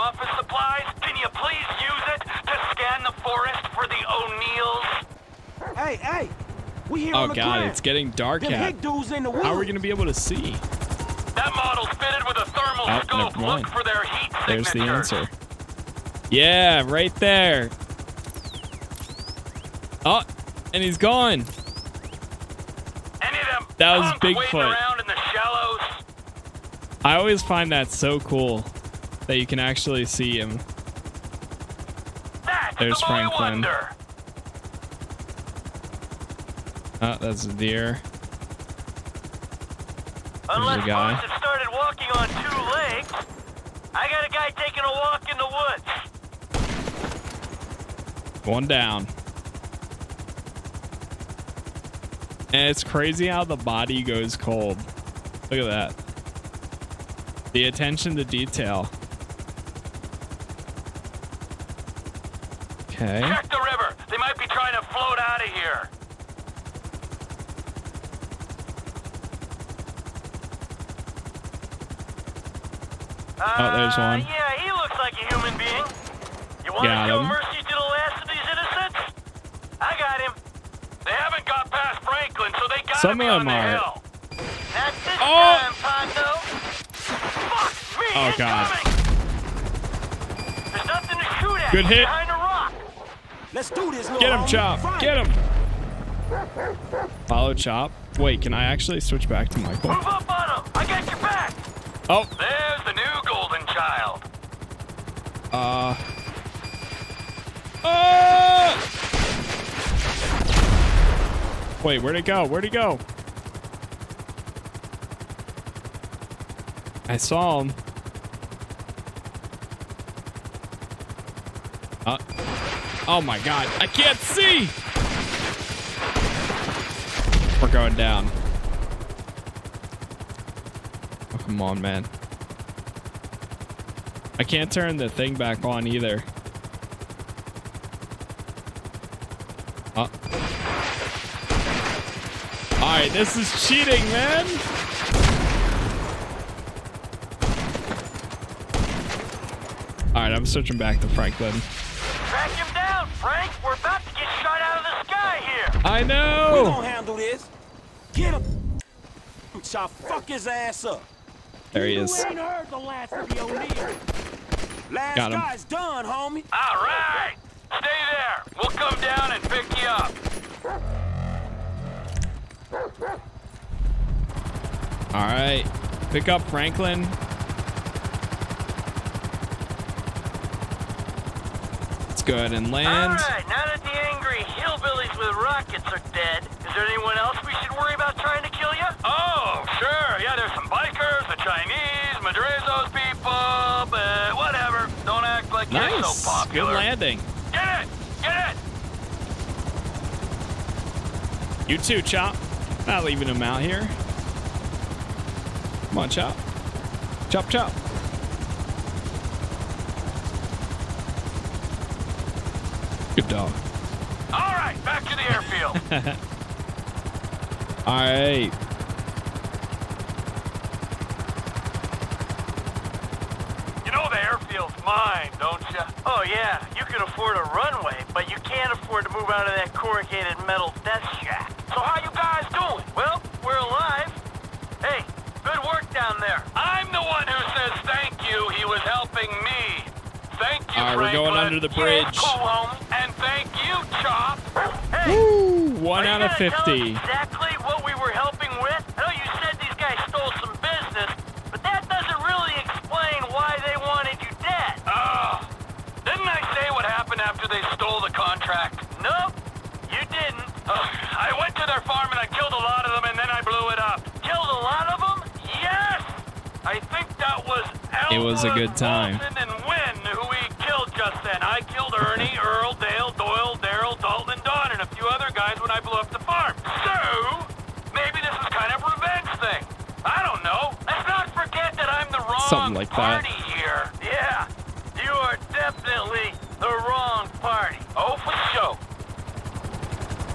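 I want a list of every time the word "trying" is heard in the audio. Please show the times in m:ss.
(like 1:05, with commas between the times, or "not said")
1:04, 3:08.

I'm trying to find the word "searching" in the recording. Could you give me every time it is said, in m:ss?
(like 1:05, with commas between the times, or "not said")
2:30.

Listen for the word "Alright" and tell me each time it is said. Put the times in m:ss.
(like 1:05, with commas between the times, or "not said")
2:22, 2:30.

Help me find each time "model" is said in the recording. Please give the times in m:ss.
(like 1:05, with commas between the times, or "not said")
0:11.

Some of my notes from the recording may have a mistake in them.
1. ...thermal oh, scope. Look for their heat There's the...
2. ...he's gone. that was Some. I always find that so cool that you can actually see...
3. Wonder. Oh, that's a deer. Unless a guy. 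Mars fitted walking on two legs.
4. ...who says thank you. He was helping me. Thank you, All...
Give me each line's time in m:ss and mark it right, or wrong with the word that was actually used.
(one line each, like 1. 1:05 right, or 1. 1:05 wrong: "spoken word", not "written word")
1. 0:12 right
2. 0:20 wrong: "Bigfoot", not "Some"
3. 0:33 wrong: "started", not "fitted"
4. 3:57 right.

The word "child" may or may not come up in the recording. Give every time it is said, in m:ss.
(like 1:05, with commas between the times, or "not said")
1:43.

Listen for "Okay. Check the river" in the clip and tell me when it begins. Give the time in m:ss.
1:02.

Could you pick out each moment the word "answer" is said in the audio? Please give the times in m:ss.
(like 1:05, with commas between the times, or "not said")
0:14.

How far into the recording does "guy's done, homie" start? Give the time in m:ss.
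2:45.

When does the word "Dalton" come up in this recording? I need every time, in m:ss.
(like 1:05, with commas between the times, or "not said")
4:34.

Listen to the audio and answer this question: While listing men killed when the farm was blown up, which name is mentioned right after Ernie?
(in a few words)
Earl.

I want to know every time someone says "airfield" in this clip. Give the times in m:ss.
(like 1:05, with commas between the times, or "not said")
3:35, 3:44.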